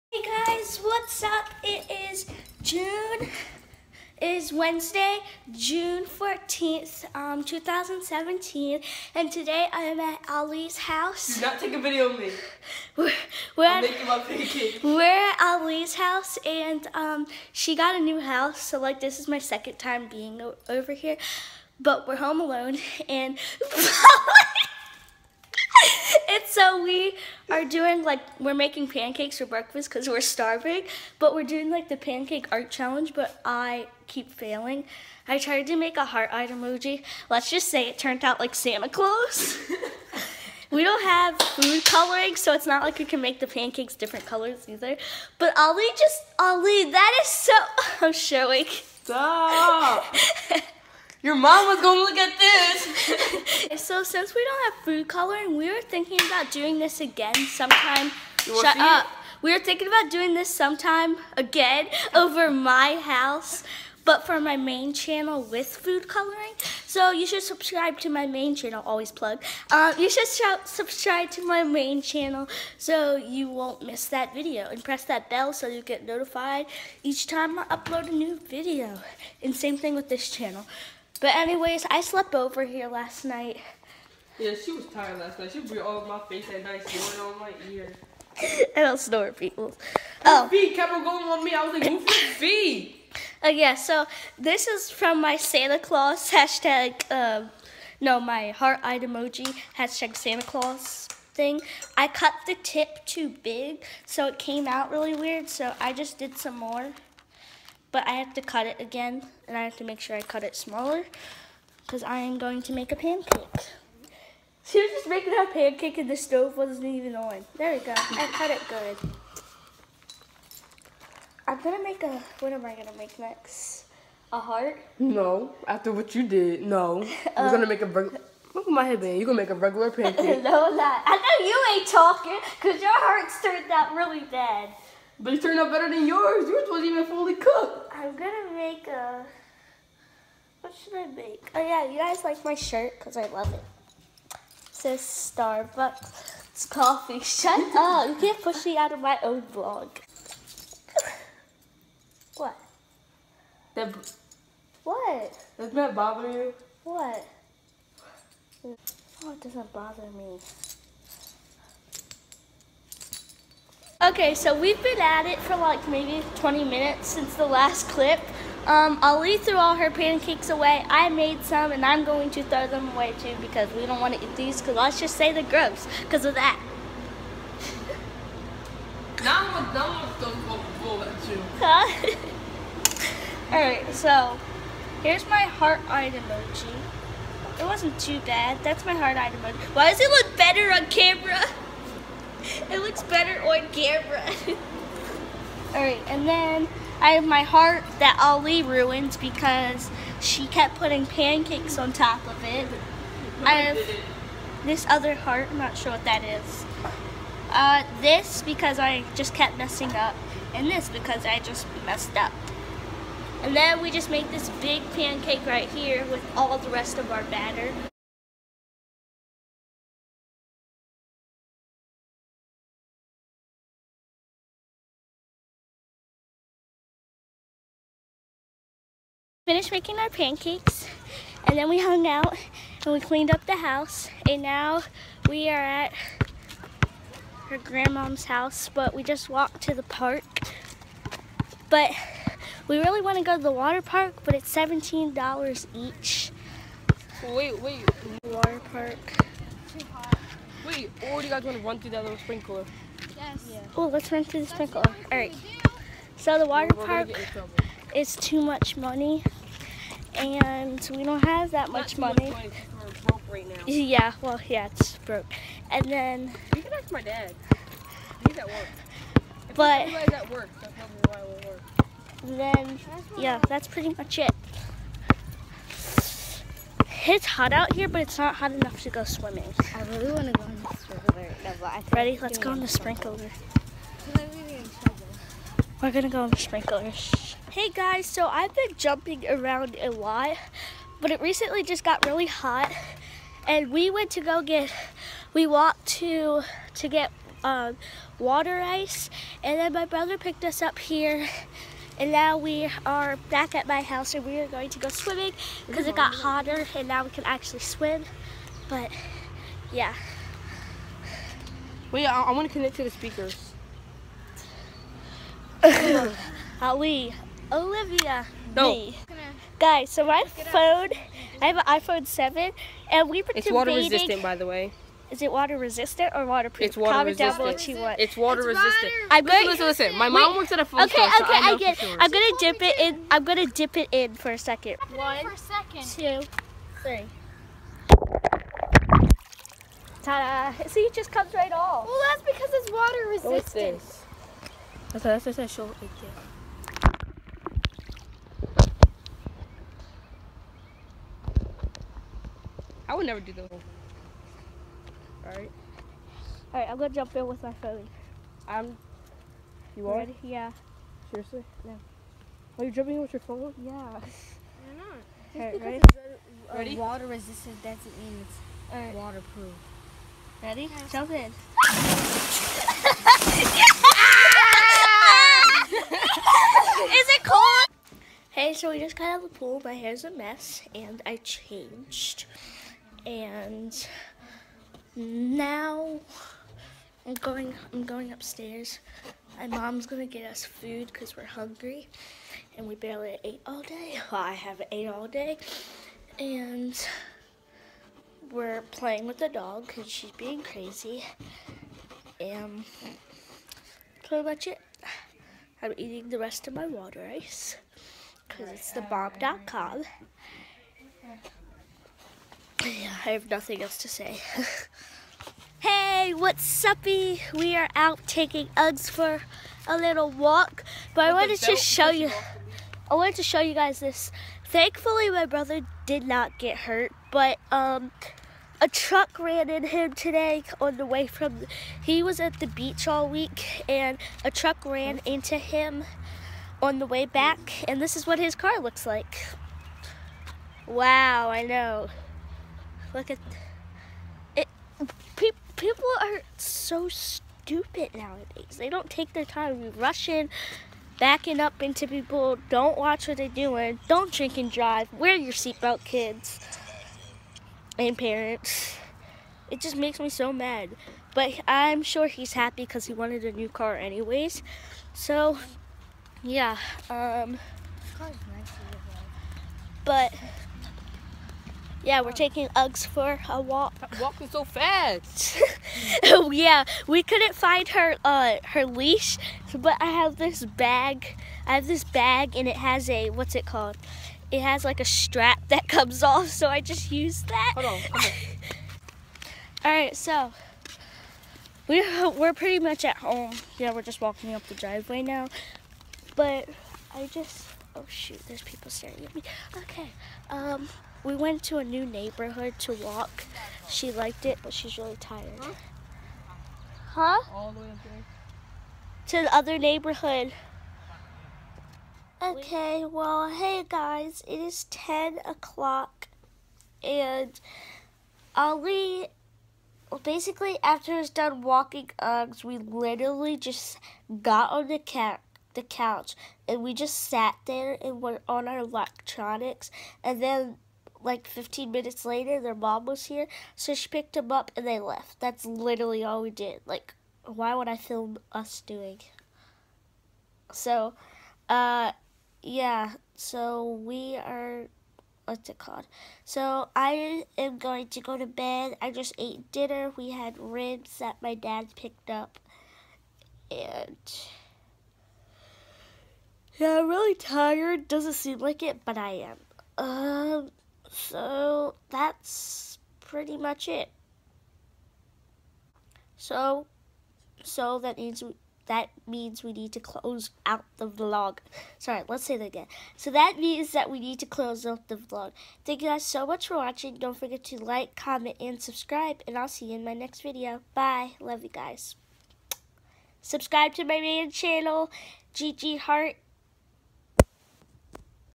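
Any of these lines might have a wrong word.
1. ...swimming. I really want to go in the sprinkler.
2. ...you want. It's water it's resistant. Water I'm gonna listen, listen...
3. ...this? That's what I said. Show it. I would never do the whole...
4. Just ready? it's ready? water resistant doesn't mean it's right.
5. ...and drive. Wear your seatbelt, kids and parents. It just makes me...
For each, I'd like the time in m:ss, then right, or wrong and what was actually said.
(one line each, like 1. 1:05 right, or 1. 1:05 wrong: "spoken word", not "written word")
1. 4:39 right
2. 5:27 right
3. 5:43 right
4. 6:05 right
5. 7:34 right.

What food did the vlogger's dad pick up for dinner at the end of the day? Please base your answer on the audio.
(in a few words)
Ribs.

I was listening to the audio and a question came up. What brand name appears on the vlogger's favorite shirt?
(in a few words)
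Starbucks.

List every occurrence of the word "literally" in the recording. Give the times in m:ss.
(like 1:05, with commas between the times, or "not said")
8:42, 8:55.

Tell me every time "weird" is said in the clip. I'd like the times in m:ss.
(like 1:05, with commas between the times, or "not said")
1:45.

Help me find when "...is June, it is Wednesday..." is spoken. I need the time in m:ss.
0:02.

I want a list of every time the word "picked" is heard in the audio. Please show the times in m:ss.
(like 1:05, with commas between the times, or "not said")
5:00, 8:53, 9:11.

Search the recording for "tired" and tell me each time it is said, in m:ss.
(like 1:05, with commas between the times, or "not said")
1:24, 8:24, 9:17.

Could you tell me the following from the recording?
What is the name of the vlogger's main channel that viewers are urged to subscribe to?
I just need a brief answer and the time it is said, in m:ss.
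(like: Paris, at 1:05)
Gigi Harte, at 9:45.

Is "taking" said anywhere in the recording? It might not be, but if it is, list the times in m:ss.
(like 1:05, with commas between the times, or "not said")
6:58, 7:52.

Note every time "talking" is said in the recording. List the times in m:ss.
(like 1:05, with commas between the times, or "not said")
2:11.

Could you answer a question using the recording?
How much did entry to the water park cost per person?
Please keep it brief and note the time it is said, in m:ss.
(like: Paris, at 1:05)
$17, at 4:04.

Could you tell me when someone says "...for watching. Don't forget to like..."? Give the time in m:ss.
9:36.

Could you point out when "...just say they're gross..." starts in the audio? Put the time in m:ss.
2:54.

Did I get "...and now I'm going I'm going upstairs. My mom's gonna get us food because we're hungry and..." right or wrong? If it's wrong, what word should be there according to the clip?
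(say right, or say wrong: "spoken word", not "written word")
right.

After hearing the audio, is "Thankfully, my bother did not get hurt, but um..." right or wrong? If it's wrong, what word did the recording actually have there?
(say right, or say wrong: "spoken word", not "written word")
wrong: "brother", not "bother".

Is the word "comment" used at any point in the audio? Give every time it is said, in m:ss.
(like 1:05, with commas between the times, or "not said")
5:26, 9:37.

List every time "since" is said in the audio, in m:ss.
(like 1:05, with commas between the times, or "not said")
0:54, 2:47.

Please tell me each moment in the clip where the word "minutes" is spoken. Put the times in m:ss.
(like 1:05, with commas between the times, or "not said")
2:46, 8:51.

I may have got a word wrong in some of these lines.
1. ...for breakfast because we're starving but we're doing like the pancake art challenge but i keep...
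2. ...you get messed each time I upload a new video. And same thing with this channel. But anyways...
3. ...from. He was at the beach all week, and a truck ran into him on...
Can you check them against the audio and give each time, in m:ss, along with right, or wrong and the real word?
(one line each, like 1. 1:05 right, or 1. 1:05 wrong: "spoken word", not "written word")
1. 0:29 right
2. 1:15 wrong: "notified", not "messed"
3. 7:11 right.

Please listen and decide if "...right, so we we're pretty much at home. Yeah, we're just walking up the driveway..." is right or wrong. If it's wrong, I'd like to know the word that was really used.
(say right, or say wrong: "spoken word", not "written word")
right.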